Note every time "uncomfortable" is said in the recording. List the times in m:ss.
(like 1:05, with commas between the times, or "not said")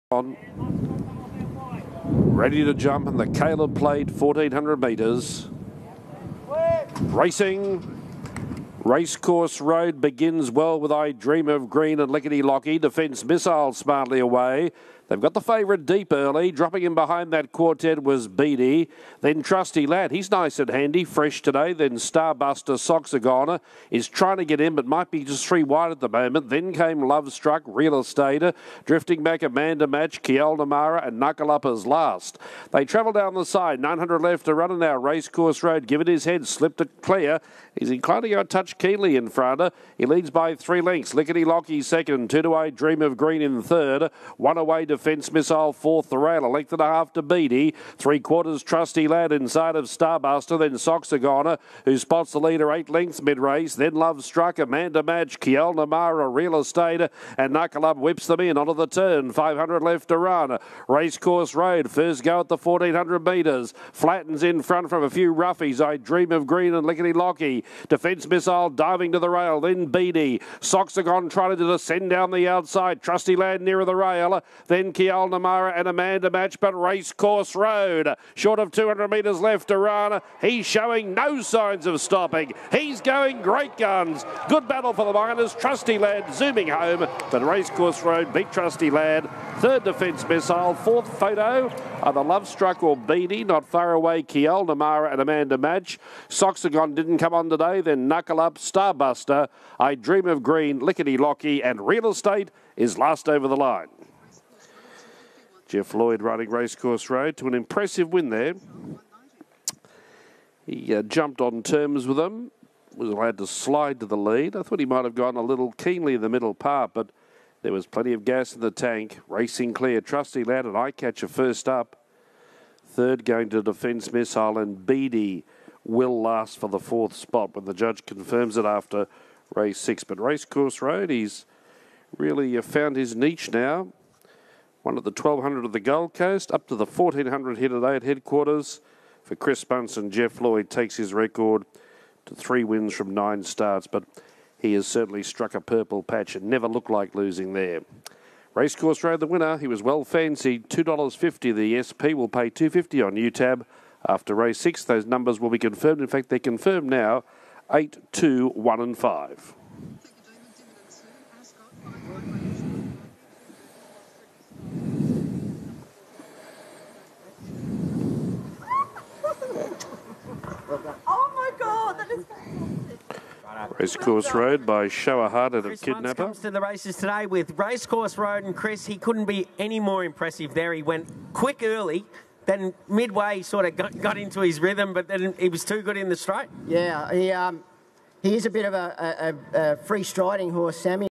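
not said.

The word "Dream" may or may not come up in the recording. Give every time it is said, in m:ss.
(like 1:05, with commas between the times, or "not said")
0:11, 0:42, 1:05, 1:39.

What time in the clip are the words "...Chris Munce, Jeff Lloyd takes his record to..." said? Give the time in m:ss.
2:19.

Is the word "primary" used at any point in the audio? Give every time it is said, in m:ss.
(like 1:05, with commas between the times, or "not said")
not said.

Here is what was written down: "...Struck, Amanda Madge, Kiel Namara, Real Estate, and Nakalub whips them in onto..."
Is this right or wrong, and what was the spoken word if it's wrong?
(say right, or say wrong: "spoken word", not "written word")
right.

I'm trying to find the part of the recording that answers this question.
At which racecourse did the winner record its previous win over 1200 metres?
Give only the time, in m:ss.
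2:15.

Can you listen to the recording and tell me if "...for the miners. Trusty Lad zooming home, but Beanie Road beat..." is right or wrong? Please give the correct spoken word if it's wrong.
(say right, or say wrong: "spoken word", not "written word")
wrong: "Racecourse", not "Beanie".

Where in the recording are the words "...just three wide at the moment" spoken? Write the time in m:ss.
0:25.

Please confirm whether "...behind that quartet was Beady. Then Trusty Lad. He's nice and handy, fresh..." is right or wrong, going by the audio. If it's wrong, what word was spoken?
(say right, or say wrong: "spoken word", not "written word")
right.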